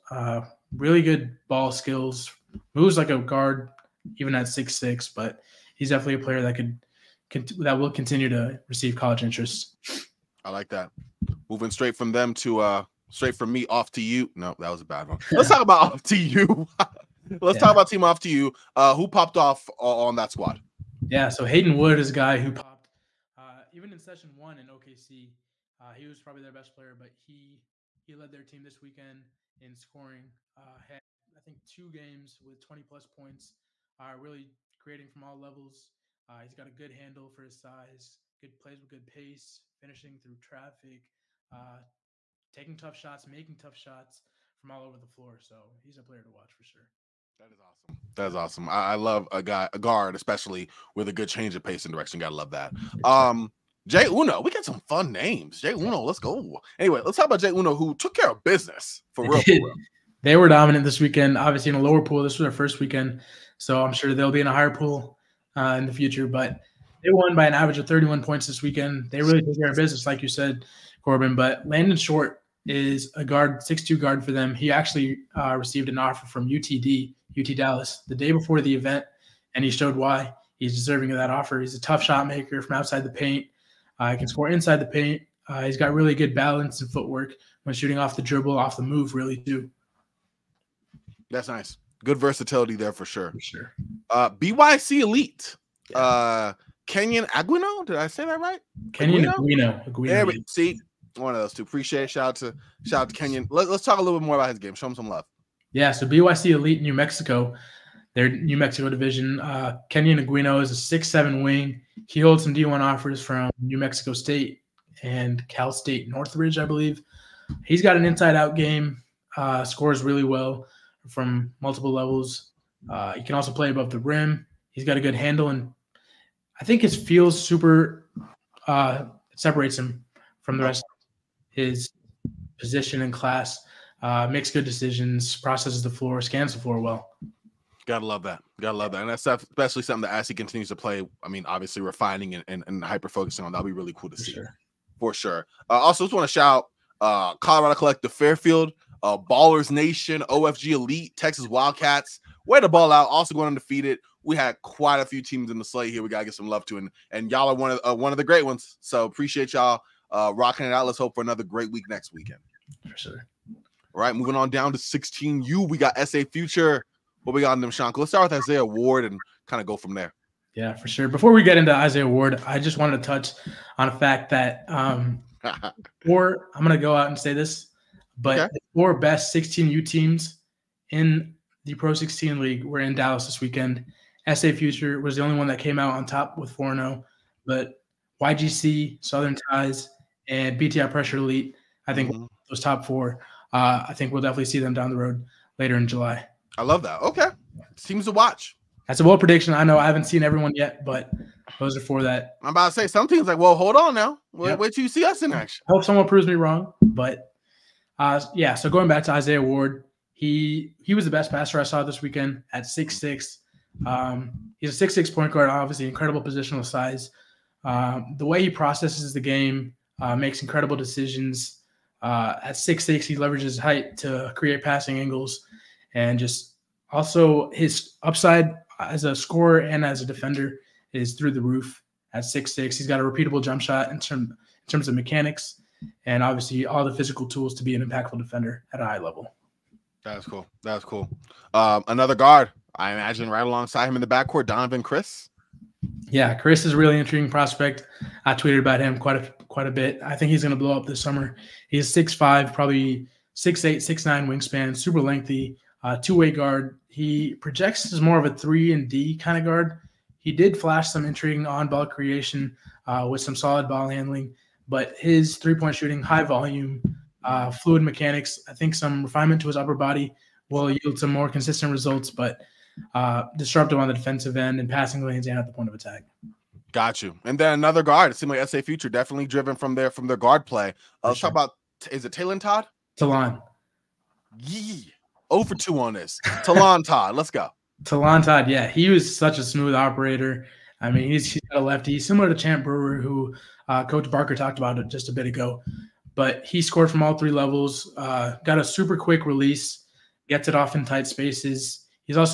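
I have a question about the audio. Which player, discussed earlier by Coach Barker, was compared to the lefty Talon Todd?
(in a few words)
Champ Brewer.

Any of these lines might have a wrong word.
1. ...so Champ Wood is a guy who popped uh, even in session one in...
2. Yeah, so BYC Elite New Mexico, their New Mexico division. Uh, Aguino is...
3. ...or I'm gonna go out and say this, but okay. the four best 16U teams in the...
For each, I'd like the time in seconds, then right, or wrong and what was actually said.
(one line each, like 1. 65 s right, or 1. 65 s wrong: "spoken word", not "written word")
1. 21 s wrong: "Hayden", not "Champ"
2. 105 s right
3. 176 s right.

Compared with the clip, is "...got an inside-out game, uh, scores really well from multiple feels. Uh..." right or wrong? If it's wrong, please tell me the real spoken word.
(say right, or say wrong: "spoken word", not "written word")
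wrong: "levels", not "feels".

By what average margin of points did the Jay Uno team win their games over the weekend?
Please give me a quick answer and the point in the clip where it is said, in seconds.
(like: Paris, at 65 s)
31, at 67 s.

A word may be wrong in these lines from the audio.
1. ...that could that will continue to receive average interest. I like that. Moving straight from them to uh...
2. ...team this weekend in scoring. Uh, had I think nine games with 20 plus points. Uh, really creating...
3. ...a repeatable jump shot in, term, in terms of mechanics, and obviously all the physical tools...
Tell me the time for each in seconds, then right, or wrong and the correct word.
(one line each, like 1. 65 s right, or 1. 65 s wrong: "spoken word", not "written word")
1. 6 s wrong: "college", not "average"
2. 28 s wrong: "two", not "nine"
3. 233 s right.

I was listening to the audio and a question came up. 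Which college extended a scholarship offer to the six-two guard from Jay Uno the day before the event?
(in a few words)
UT Dallas.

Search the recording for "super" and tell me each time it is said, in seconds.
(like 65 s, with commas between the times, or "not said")
127 s, 254 s, 298 s.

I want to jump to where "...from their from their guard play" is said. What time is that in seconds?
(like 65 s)
279 s.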